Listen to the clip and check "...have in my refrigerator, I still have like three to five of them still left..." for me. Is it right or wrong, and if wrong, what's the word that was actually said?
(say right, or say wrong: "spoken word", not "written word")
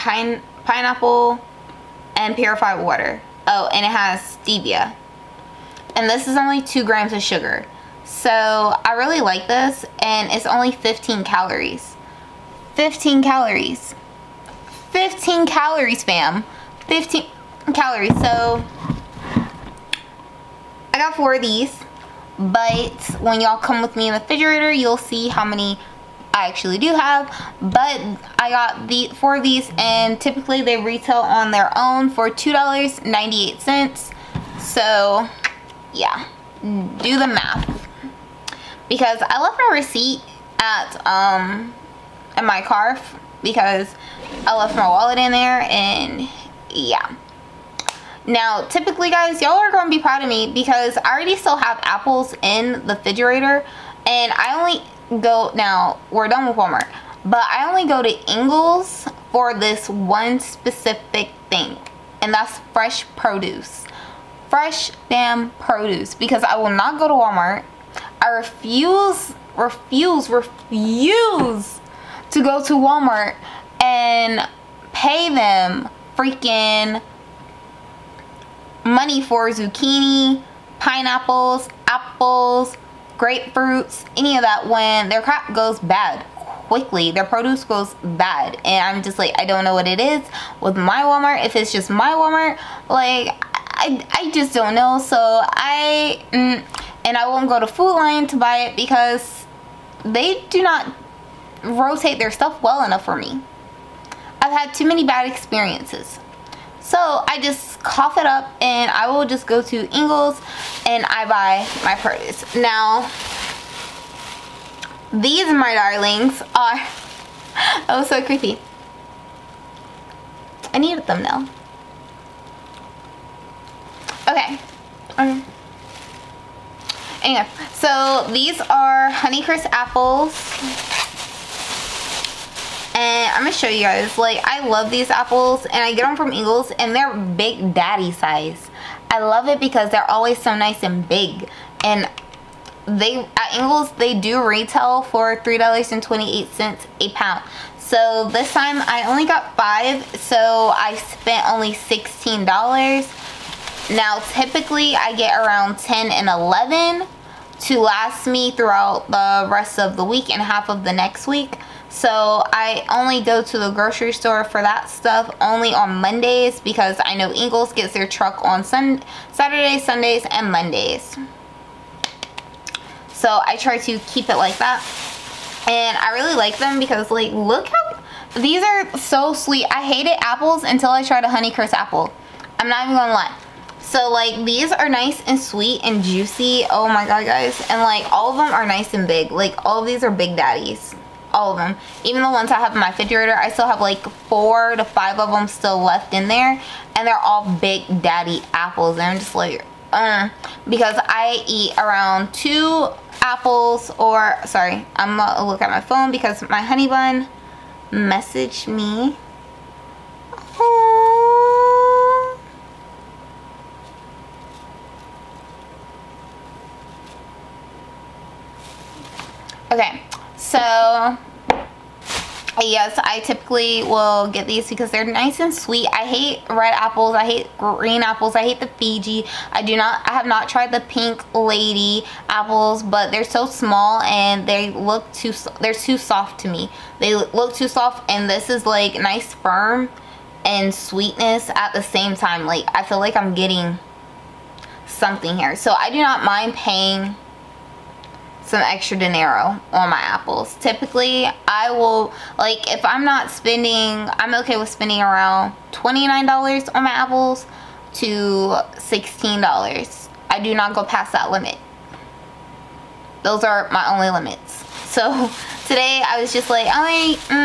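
wrong: "four", not "three".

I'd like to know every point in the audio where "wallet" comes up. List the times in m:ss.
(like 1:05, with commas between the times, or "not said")
0:44.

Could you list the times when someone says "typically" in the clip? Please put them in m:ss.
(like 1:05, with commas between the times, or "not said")
0:30, 0:48, 2:34, 3:43, 4:10.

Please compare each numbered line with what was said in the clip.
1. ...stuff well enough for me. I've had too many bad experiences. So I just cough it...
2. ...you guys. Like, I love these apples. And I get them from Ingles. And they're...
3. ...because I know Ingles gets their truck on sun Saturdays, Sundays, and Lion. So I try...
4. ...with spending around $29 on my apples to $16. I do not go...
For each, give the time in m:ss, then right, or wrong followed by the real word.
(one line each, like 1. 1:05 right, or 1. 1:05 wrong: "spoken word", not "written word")
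1. 1:42 right
2. 2:13 right
3. 2:46 wrong: "Mondays", not "Lion"
4. 4:14 right.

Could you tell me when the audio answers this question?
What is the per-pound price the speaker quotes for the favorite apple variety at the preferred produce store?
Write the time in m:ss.
2:25.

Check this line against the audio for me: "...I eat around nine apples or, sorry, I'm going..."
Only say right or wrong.
wrong.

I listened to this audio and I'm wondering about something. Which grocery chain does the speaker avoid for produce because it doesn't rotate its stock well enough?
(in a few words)
Food Lion.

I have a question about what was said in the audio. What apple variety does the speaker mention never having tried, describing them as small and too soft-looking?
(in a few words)
Pink Lady.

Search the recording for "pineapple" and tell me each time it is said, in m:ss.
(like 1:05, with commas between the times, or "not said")
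0:00, 1:20.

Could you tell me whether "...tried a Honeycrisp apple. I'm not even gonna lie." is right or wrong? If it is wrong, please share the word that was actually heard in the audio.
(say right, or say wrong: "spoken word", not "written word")
right.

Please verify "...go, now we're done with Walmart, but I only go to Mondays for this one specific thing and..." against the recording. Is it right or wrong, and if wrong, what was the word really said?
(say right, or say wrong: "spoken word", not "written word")
wrong: "Ingles", not "Mondays".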